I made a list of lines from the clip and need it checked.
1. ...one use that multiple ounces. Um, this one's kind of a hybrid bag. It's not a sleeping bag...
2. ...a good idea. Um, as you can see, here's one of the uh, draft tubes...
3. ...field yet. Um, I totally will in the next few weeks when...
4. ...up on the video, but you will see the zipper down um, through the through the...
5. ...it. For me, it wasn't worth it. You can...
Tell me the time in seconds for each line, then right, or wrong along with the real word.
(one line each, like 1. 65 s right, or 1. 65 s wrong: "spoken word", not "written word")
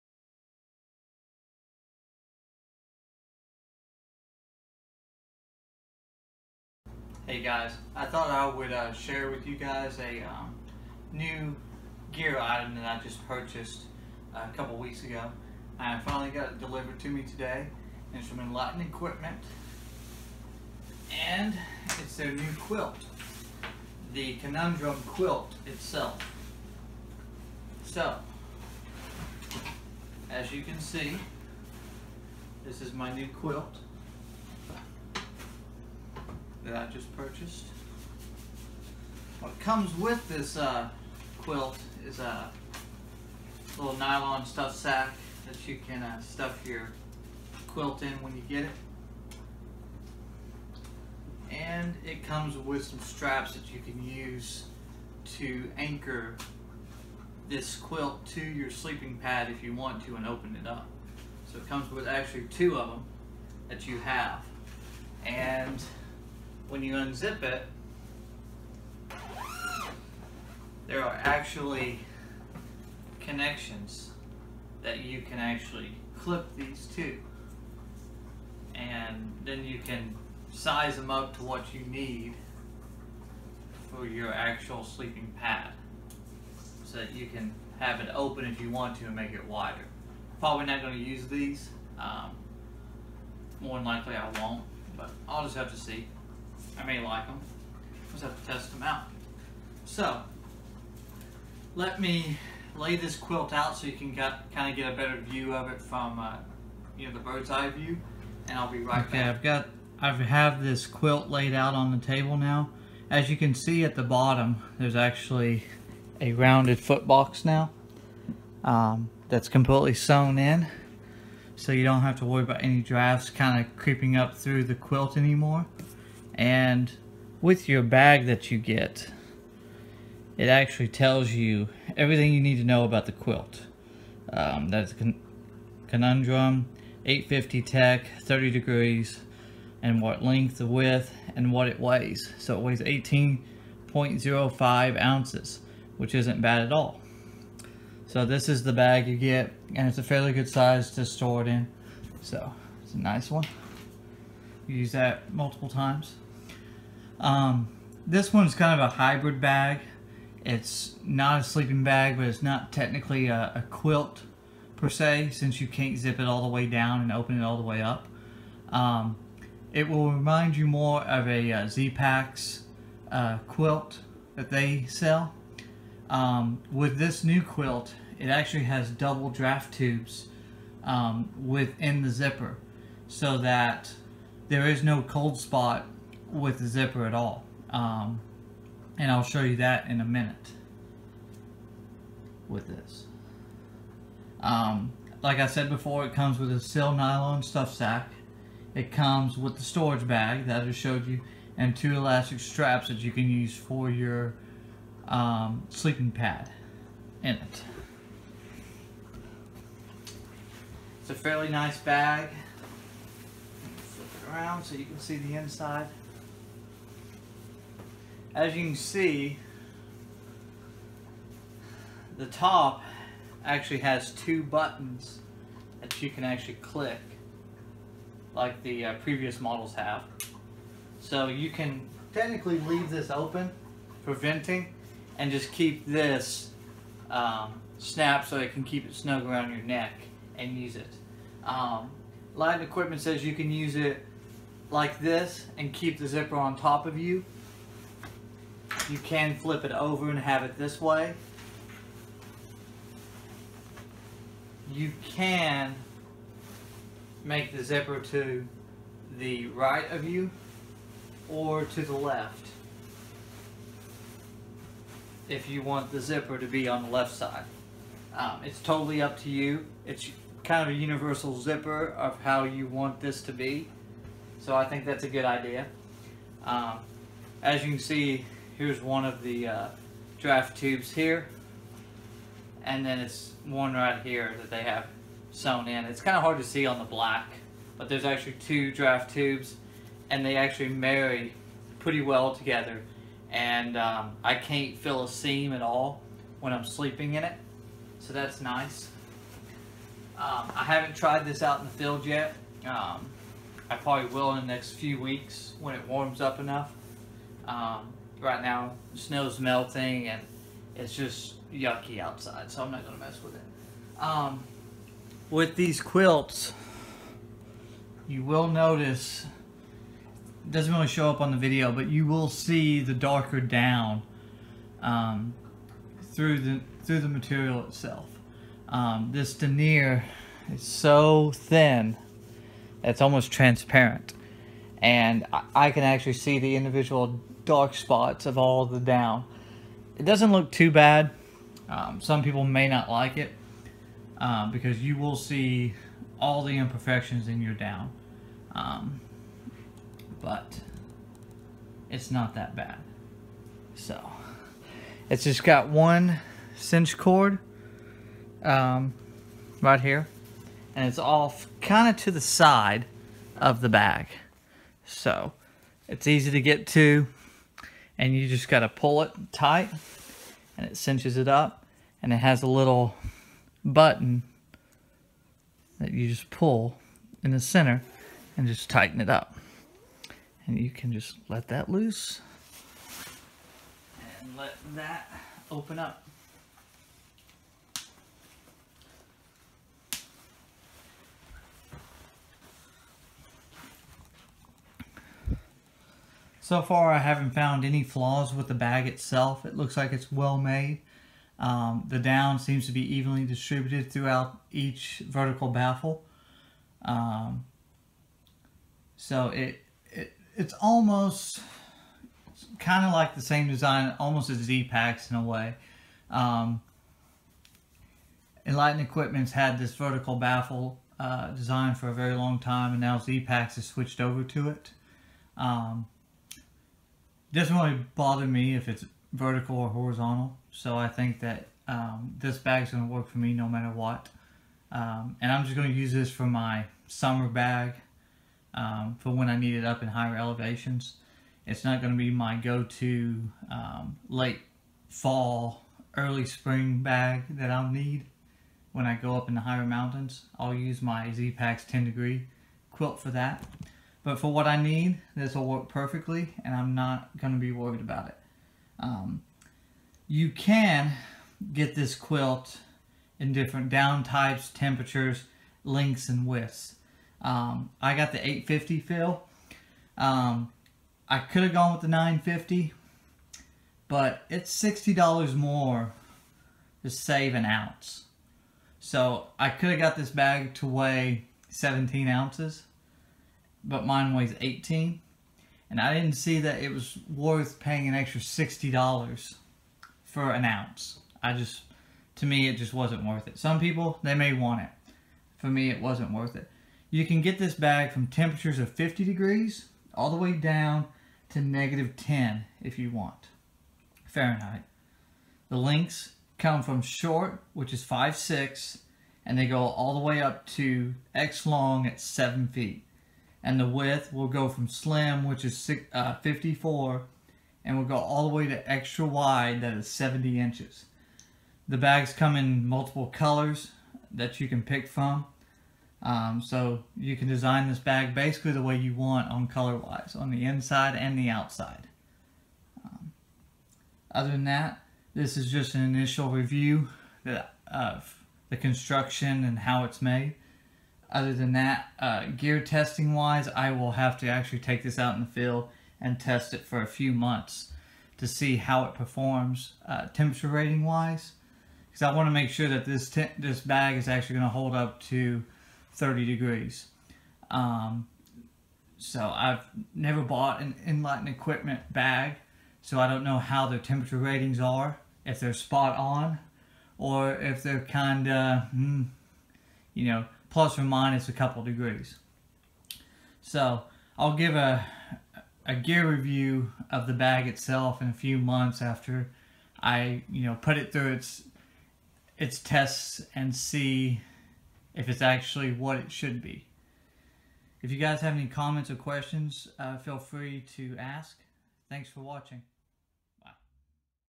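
1. 153 s wrong: "times", not "ounces"
2. 275 s right
3. 301 s wrong: "probably", not "totally"
4. 321 s wrong: "darker", not "zipper"
5. 494 s right.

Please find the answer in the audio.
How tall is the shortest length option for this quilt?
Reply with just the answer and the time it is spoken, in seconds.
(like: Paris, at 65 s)
5'6", at 507 s.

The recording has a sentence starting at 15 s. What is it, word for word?
I finally got it delivered to me today.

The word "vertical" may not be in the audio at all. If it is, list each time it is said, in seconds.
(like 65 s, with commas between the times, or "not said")
405 s, 419 s, 429 s.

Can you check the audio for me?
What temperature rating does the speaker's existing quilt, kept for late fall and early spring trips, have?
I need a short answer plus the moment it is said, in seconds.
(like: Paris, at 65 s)
10 degrees, at 451 s.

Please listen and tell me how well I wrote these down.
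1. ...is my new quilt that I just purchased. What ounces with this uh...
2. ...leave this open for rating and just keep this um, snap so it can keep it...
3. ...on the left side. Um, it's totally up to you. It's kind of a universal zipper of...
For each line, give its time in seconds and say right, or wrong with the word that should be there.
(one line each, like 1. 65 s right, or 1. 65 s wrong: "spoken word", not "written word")
1. 32 s wrong: "comes", not "ounces"
2. 232 s wrong: "venting", not "rating"
3. 266 s right.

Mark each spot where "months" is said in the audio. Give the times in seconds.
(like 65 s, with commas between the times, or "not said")
547 s, 578 s.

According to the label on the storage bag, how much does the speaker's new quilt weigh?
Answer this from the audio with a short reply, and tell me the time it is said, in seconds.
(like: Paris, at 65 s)
18.05 ounces, at 142 s.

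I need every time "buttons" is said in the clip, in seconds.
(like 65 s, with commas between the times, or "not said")
224 s, 373 s.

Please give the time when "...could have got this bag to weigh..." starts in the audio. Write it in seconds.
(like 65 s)
479 s.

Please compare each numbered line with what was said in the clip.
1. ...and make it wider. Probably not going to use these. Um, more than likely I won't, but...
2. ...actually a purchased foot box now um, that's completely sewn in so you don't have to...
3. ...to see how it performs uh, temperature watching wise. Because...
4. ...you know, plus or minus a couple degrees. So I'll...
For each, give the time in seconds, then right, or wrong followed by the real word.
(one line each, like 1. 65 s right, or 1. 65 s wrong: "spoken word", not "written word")
1. 89 s right
2. 114 s wrong: "rounded", not "purchased"
3. 548 s wrong: "rating", not "watching"
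4. 569 s right.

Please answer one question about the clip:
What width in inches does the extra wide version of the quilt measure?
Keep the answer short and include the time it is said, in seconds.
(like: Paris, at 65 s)
70 inches, at 519 s.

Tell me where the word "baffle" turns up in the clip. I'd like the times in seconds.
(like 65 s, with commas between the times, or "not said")
405 s, 420 s.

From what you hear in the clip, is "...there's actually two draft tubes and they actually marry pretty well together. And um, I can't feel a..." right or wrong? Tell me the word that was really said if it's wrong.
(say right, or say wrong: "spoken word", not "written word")
right.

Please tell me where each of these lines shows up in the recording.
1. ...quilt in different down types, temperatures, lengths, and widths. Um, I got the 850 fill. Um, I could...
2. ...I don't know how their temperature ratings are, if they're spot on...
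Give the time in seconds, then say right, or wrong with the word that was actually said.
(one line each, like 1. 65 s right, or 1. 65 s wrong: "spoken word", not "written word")
1. 461 s right
2. 563 s right.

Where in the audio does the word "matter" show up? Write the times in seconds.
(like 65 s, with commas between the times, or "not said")
433 s.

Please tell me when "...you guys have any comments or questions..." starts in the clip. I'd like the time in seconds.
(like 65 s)
587 s.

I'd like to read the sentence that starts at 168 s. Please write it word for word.
Um, it will remind you more of a uh, Z-Packs uh, quilt that they sell.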